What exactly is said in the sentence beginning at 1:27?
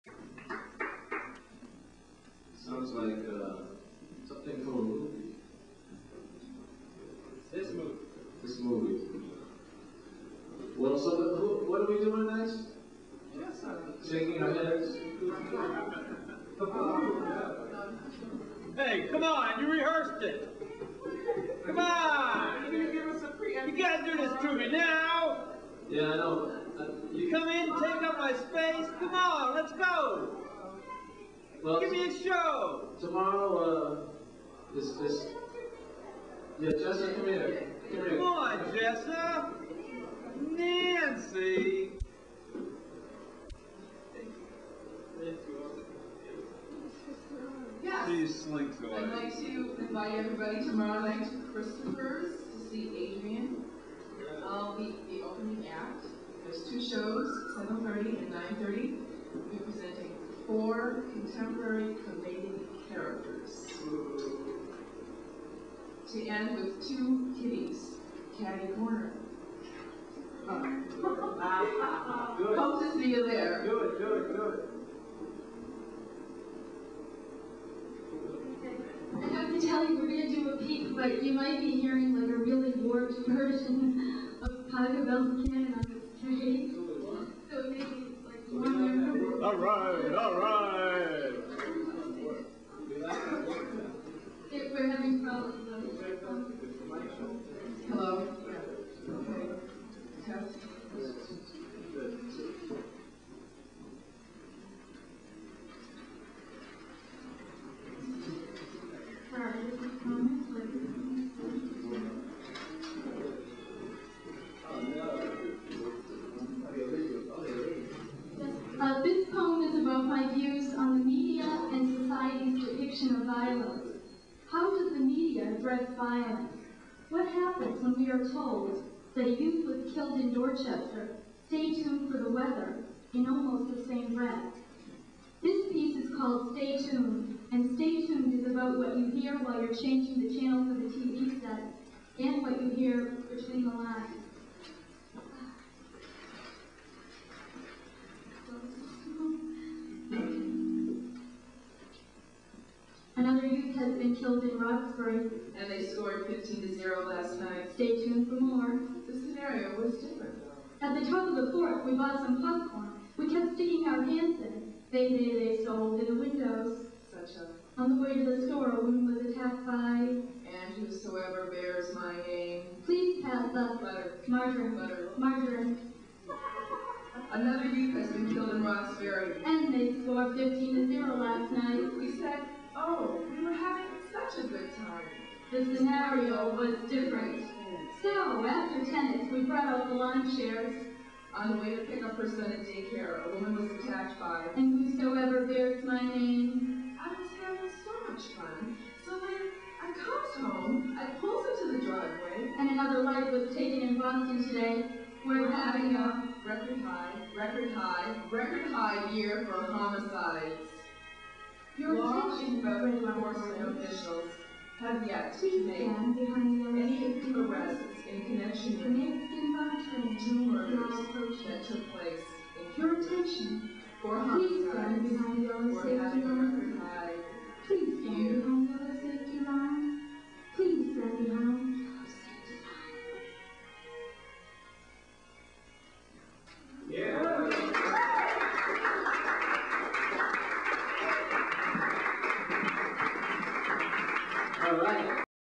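So maybe like one All right, all right.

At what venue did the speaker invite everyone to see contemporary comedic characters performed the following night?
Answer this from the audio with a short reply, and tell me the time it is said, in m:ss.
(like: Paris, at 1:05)
Christopher's, at 0:51.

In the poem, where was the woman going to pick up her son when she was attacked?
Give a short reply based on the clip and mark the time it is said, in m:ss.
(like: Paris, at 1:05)
Daycare, at 3:12.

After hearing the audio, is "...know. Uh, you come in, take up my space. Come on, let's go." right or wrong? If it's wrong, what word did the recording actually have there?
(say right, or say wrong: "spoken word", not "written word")
right.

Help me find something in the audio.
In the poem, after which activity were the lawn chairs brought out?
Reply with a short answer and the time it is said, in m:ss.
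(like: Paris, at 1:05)
Tennis, at 3:08.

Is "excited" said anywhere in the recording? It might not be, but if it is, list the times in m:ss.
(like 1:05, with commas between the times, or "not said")
not said.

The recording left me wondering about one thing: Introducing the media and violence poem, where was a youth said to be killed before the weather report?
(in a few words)
Dorchester.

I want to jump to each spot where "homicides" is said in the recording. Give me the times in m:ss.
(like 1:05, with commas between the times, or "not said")
3:29, 3:44.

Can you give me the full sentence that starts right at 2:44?
They, they, they stole in the windows.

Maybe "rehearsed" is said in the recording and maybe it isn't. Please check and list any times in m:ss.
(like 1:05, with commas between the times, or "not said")
0:19.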